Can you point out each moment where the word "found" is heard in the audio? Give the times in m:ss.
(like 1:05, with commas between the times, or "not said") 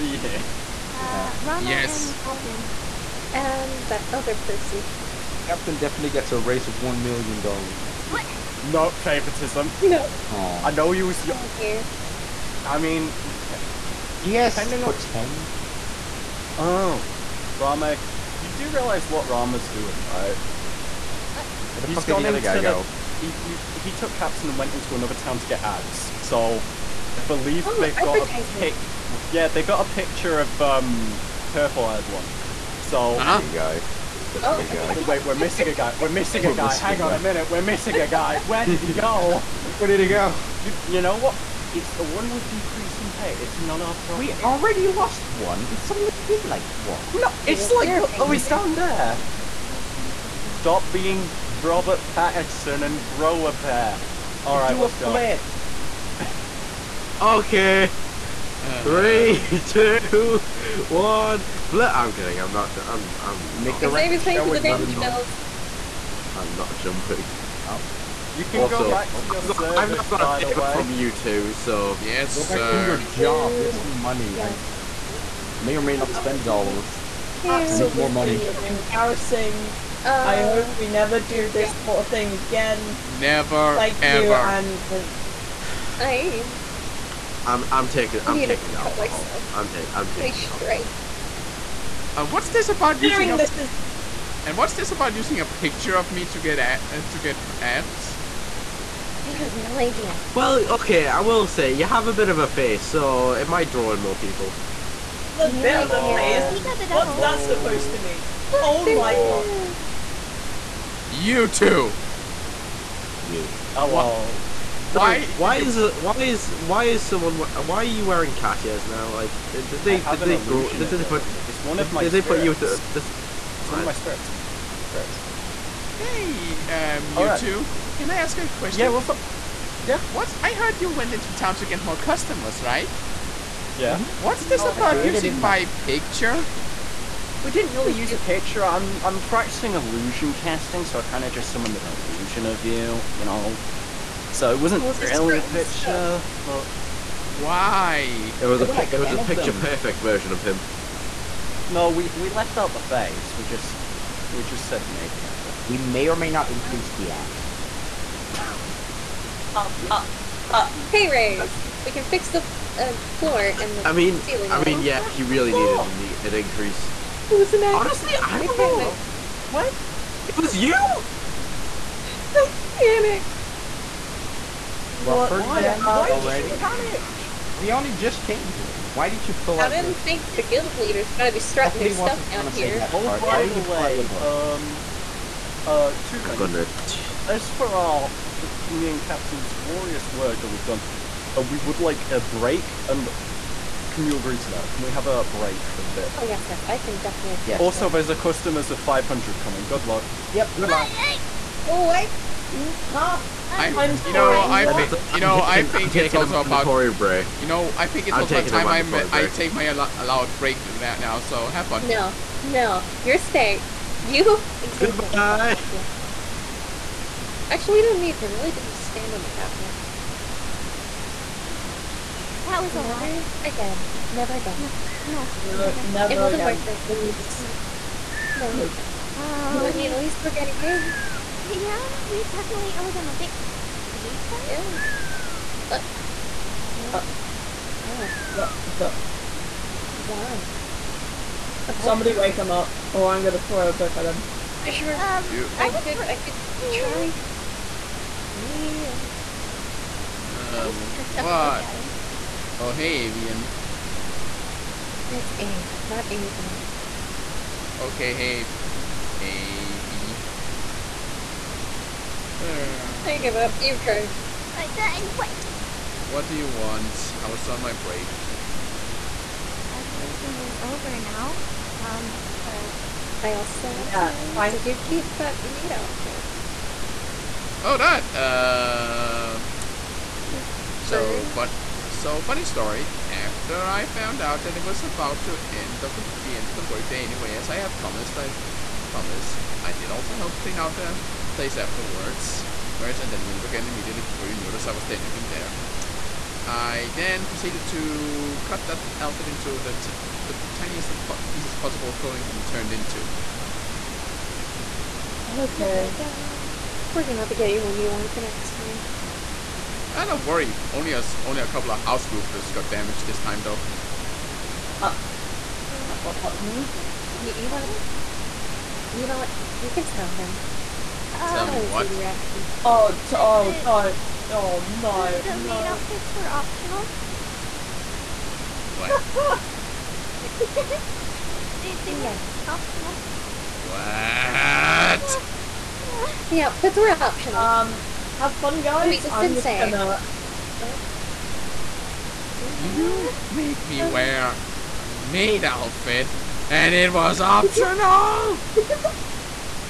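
4:43.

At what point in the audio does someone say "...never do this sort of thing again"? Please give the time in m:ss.
1:20.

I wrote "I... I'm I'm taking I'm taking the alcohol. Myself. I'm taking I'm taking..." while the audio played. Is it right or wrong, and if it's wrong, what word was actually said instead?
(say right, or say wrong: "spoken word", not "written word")
right.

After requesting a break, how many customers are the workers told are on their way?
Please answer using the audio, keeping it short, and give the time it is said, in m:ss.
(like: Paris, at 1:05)
500, at 3:18.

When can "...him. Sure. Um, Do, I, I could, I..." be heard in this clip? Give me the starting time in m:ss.
4:04.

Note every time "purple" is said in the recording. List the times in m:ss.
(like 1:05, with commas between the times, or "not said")
0:31.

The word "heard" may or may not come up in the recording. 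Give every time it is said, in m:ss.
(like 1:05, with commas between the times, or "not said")
2:10.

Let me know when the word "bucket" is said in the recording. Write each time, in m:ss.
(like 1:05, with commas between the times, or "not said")
not said.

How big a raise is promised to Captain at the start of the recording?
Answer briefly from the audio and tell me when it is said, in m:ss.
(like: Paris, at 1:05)
$1 million, at 0:06.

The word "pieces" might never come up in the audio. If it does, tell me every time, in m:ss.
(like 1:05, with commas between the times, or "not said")
5:01.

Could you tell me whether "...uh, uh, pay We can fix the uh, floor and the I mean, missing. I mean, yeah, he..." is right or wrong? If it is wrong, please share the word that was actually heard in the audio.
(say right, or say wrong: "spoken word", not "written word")
wrong: "ceiling", not "missing".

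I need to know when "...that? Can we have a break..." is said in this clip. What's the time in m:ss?
3:14.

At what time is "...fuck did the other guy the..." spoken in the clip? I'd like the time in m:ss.
0:21.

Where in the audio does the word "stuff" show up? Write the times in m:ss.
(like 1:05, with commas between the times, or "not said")
2:25, 3:01.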